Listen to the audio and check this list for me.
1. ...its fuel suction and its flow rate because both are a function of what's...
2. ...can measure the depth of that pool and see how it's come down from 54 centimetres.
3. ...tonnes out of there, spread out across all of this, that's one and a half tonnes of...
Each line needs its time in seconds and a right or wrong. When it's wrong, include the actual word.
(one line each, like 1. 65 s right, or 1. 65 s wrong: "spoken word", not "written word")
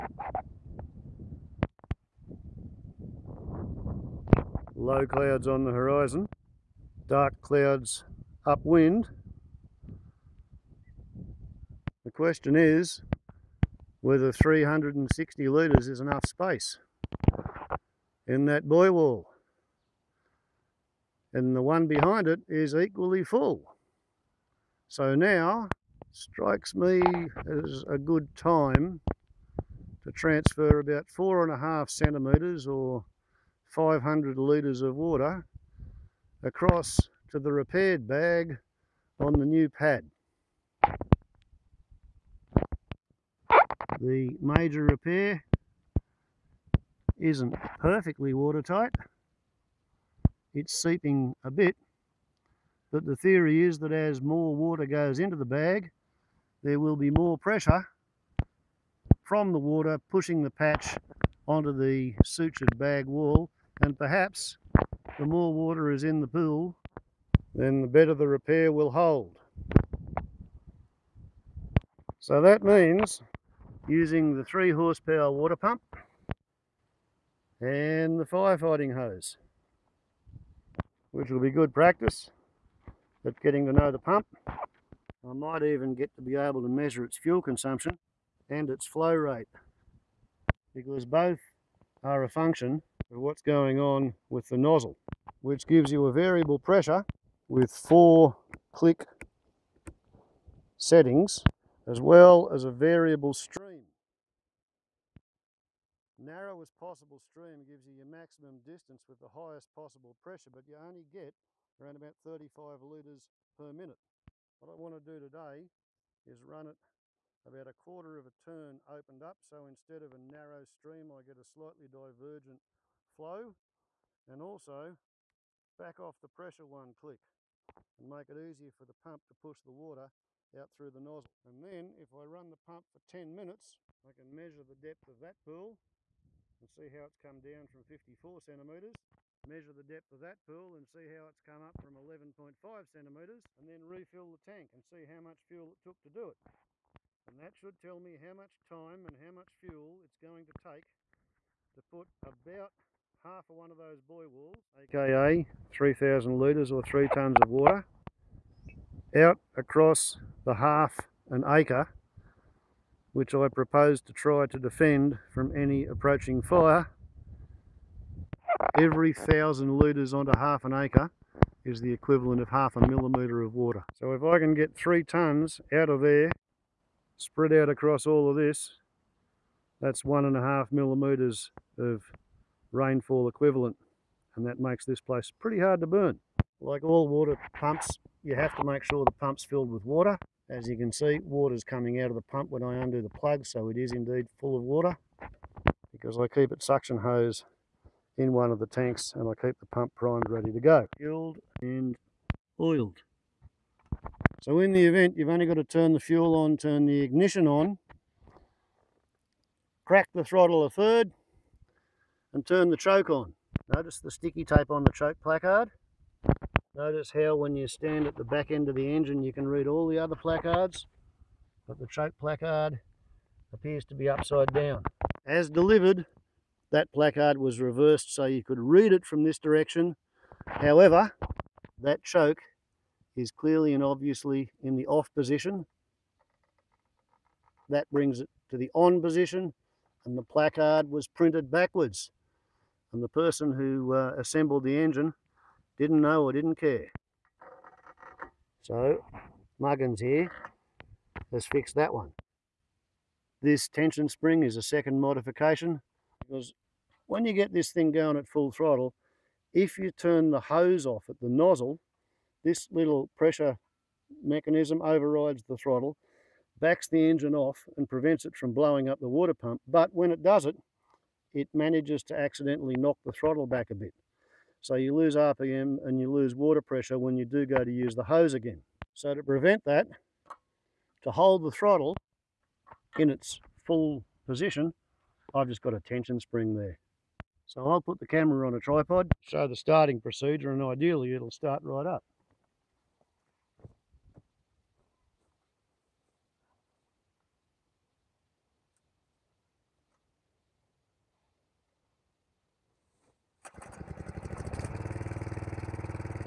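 1. 87 s wrong: "consumption", not "suction"
2. 134 s right
3. 175 s wrong: "millimetres", not "tonnes".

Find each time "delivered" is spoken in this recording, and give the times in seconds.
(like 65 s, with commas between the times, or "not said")
225 s.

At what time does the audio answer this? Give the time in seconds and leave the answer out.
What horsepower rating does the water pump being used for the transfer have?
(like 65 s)
74 s.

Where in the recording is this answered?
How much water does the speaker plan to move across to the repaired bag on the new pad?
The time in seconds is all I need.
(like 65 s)
33 s.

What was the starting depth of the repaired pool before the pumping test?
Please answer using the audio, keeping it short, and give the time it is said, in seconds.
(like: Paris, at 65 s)
11.5 centimetres, at 141 s.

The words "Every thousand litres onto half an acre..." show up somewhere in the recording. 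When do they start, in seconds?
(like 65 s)
168 s.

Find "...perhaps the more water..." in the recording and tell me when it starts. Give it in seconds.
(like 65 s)
63 s.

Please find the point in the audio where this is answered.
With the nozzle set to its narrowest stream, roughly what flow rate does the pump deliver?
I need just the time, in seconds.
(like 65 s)
112 s.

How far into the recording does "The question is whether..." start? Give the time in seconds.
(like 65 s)
12 s.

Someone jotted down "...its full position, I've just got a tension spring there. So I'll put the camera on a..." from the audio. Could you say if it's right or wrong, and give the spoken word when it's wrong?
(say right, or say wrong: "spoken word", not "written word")
right.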